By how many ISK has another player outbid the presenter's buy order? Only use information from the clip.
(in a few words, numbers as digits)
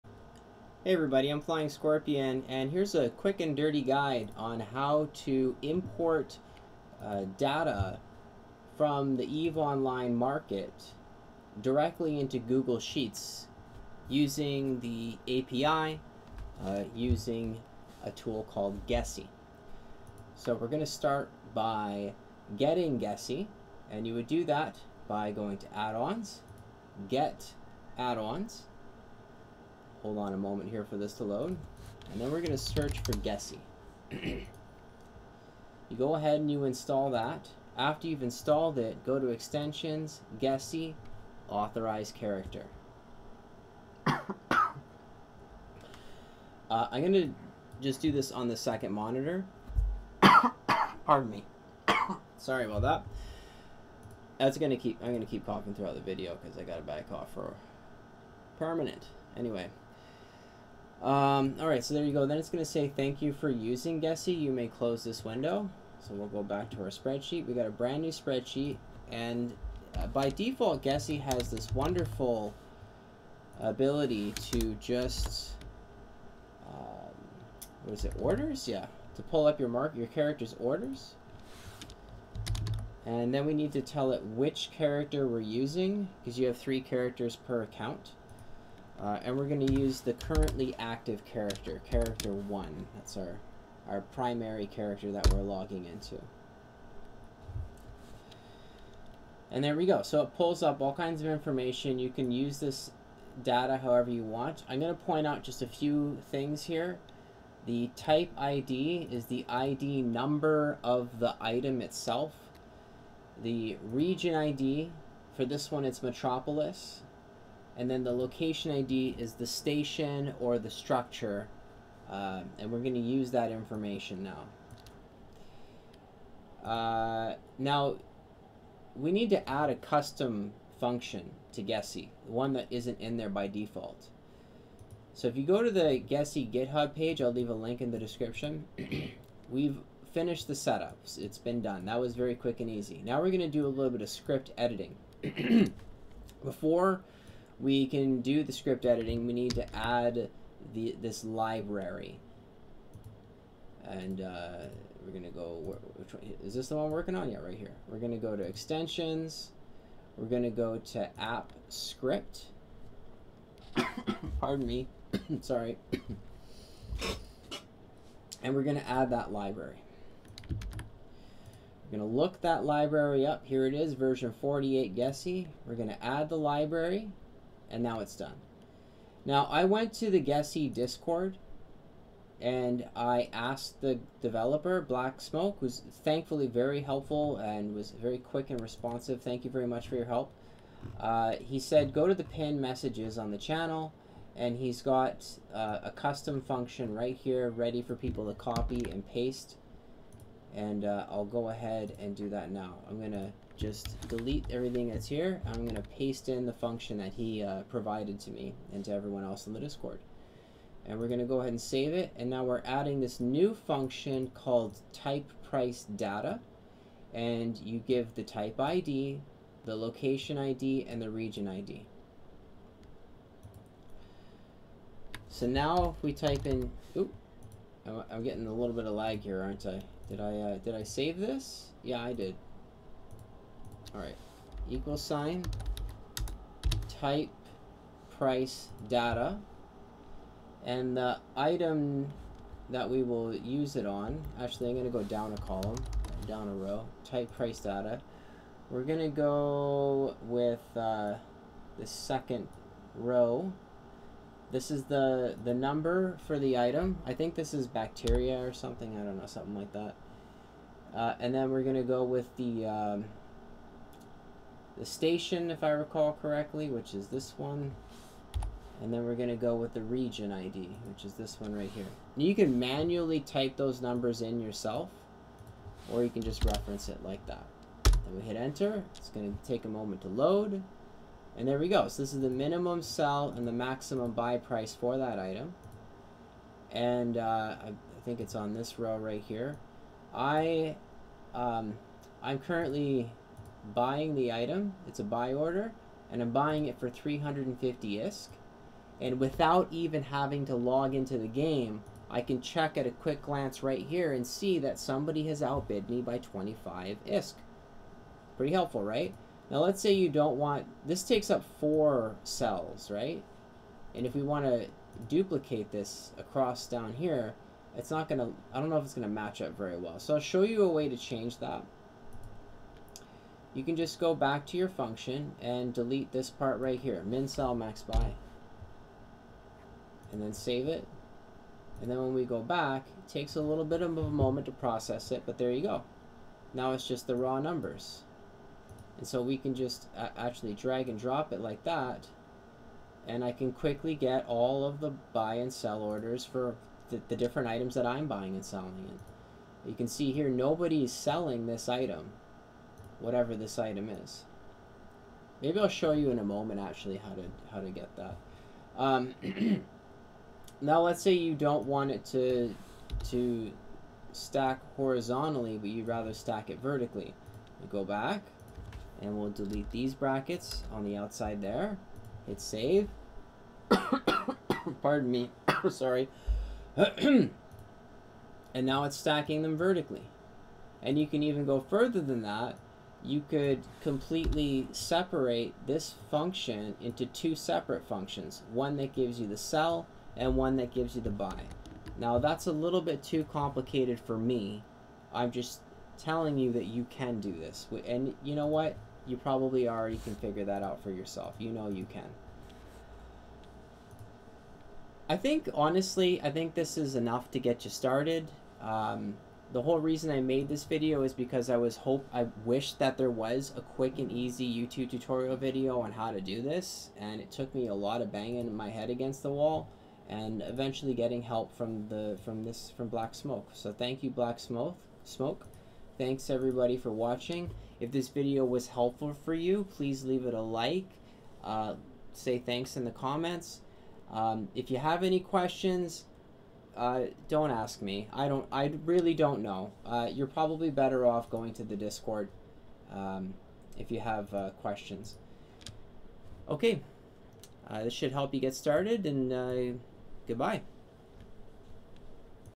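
25 ISK.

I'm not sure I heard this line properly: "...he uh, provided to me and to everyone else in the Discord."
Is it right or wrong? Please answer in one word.
right.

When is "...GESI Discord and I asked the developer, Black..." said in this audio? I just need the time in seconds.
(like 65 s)
180 s.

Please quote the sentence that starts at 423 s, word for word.
So thank you Black Smoke Smoke.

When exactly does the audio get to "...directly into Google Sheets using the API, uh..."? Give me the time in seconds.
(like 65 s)
11 s.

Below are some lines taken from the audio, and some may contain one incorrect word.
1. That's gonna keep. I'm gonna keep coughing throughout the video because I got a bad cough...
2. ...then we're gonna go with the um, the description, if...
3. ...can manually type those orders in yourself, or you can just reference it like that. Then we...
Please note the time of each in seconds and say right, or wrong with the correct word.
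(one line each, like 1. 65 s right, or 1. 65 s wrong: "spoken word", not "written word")
1. 54 s right
2. 261 s wrong: "station", not "description"
3. 272 s wrong: "numbers", not "orders".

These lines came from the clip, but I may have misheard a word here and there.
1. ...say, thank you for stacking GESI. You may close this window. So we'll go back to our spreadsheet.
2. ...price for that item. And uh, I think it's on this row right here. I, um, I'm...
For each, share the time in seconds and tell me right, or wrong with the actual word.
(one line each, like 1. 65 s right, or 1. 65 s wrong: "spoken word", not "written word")
1. 62 s wrong: "using", not "stacking"
2. 284 s right.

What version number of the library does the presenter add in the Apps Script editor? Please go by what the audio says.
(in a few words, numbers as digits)
48.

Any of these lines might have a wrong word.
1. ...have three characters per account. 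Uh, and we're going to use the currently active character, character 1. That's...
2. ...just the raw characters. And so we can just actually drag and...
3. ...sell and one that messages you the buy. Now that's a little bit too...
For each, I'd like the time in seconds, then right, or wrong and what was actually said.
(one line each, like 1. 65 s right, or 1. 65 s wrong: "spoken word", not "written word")
1. 86 s right
2. 336 s wrong: "numbers", not "characters"
3. 389 s wrong: "gives", not "messages".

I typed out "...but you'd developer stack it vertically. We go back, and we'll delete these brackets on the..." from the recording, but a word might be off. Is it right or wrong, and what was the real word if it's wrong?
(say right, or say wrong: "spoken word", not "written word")
wrong: "rather", not "developer".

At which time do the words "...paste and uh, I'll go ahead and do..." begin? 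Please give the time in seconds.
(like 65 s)
199 s.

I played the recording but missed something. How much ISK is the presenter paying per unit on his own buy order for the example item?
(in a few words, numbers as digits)
350 ISK.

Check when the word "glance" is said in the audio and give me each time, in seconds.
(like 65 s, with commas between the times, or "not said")
303 s.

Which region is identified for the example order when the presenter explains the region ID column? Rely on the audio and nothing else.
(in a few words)
Metropolis.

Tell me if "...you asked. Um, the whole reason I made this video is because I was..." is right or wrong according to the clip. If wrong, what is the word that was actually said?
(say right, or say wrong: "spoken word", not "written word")
wrong: "started", not "asked".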